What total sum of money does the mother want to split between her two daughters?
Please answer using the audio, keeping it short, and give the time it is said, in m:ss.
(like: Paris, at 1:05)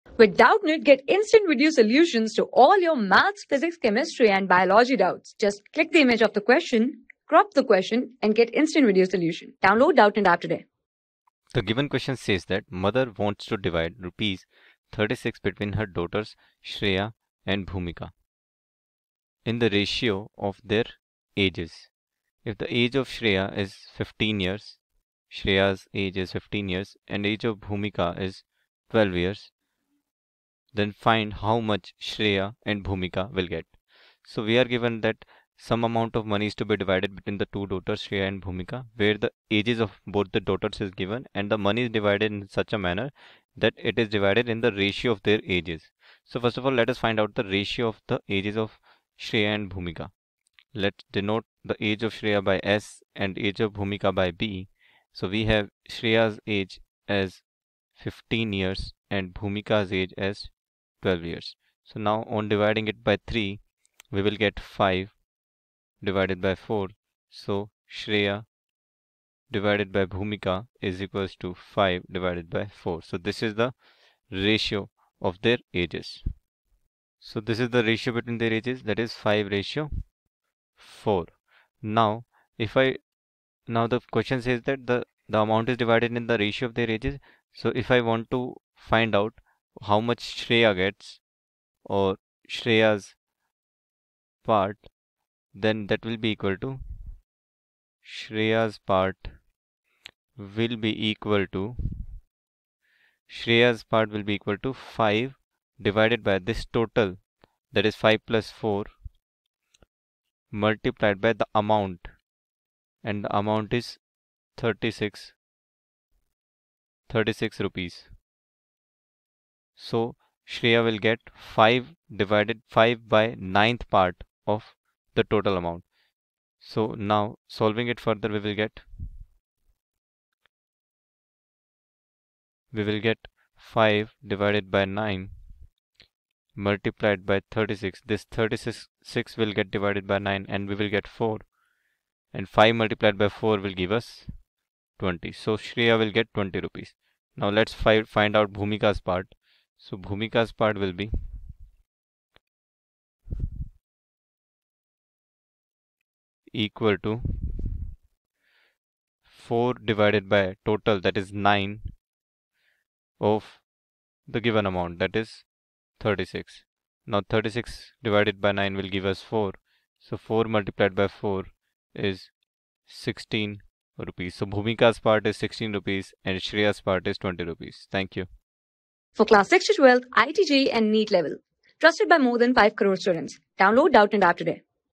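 36 rupees, at 0:13.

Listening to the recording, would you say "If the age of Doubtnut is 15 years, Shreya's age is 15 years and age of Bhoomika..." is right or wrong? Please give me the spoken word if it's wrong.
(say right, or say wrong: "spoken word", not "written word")
wrong: "Shreya", not "Doubtnut".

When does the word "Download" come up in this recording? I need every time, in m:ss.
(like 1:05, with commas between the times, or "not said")
0:09, 3:03.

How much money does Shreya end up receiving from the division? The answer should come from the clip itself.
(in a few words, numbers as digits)
20 rupees.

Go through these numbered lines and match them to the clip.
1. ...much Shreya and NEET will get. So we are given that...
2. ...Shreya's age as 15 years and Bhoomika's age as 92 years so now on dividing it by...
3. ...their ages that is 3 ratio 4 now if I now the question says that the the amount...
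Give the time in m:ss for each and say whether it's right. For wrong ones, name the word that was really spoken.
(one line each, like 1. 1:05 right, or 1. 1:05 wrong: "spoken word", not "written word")
1. 0:31 wrong: "Bhoomika", not "NEET"
2. 0:55 wrong: "12", not "92"
3. 1:18 wrong: "5", not "3".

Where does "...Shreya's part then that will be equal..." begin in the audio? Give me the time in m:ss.
1:32.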